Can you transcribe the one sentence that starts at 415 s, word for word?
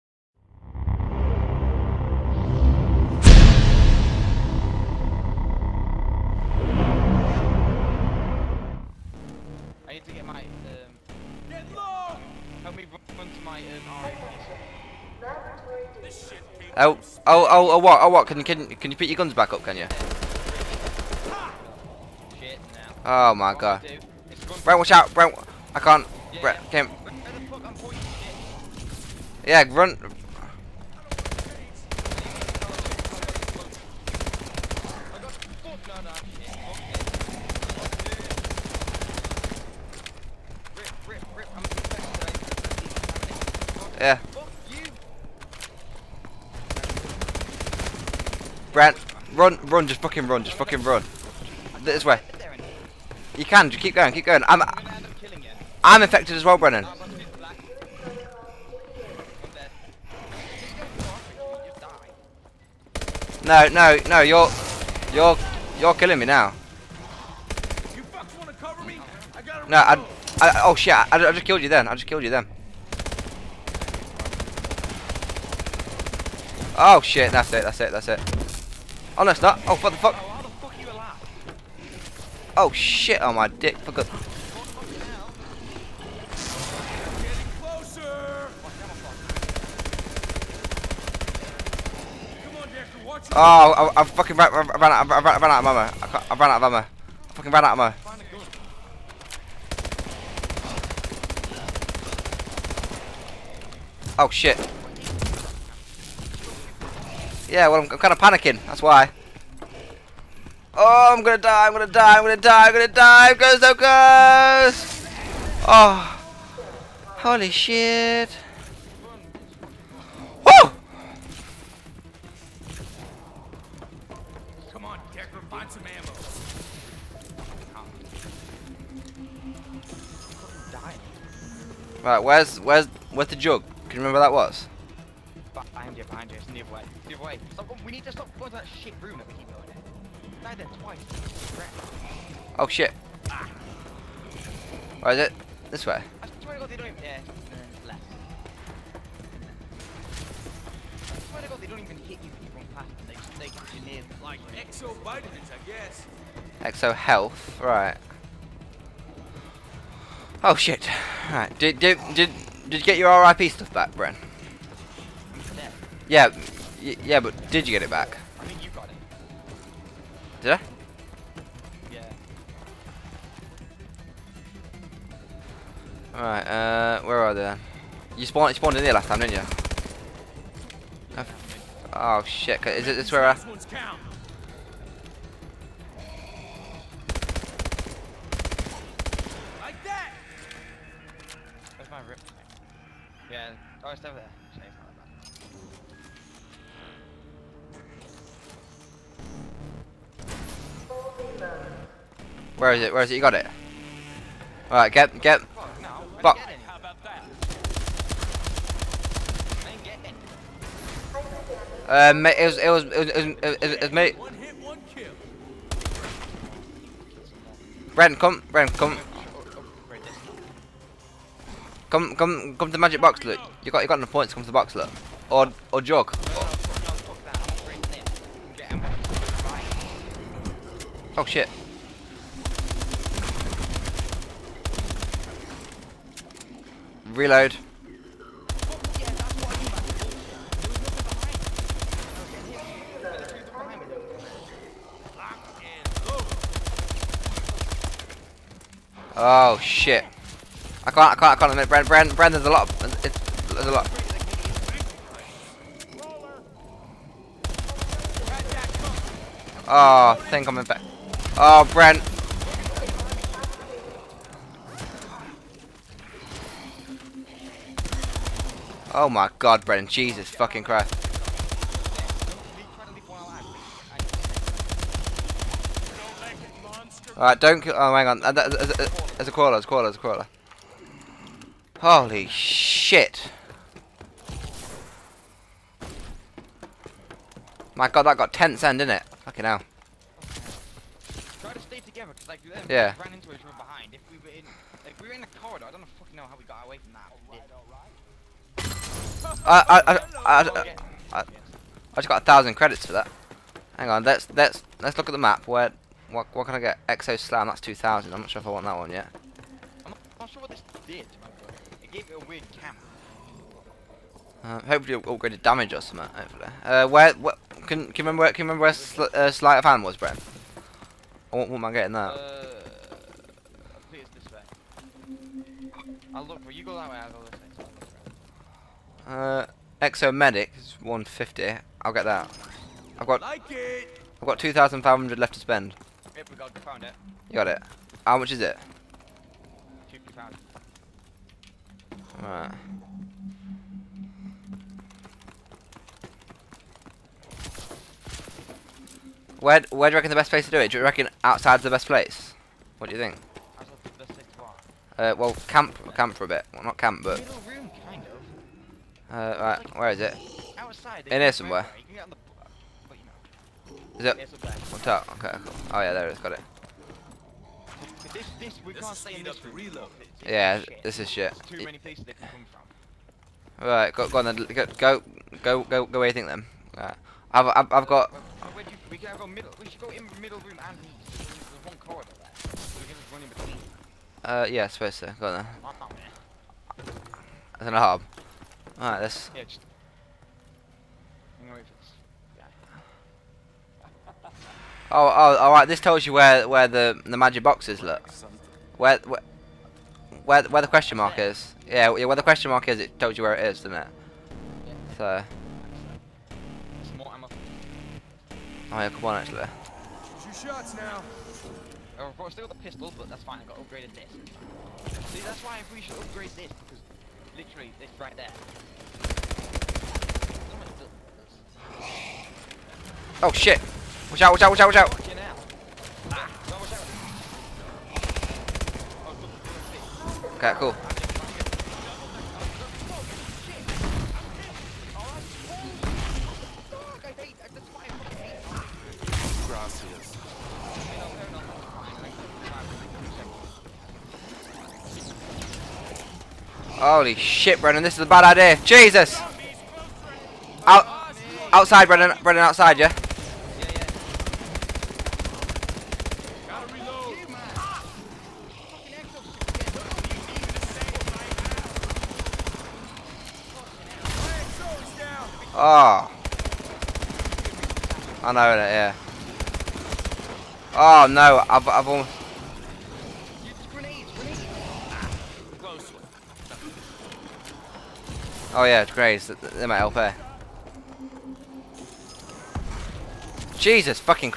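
See, that's why if we should upgrade this, because literally this right there.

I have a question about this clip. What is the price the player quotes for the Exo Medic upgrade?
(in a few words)
150.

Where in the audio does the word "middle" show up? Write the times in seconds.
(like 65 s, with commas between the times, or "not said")
380 s.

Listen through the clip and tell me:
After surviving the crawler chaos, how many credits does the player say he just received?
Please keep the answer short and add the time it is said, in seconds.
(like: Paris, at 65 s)
1000, at 302 s.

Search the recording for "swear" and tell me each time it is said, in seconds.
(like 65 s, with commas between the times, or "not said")
146 s, 151 s.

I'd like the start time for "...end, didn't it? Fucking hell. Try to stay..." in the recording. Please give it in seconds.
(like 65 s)
288 s.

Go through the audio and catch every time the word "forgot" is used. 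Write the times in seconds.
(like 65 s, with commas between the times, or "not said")
83 s.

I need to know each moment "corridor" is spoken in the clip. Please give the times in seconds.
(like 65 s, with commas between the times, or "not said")
295 s, 381 s.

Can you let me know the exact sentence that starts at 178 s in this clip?
You spawned, you spawned in here last time, didn't you?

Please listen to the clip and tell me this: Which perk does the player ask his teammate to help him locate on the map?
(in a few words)
Sleight of Hand.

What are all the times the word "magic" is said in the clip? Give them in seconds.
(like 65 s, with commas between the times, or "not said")
222 s, 397 s.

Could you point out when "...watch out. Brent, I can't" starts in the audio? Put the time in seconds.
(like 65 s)
24 s.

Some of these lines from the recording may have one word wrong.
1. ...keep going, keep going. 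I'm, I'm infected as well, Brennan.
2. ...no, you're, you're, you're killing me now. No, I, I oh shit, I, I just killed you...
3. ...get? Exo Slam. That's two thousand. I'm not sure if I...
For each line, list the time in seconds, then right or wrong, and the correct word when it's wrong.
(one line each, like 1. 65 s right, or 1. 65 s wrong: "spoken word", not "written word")
1. 53 s right
2. 64 s right
3. 306 s right.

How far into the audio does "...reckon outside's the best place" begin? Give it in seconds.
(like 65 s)
350 s.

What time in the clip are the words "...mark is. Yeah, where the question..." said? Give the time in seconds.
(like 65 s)
400 s.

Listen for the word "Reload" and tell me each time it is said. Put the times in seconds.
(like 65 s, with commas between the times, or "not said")
237 s.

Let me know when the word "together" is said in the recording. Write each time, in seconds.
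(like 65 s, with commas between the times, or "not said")
291 s.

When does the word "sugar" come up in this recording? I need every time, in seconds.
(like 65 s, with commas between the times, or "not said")
not said.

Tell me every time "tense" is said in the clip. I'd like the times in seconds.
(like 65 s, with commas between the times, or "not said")
288 s.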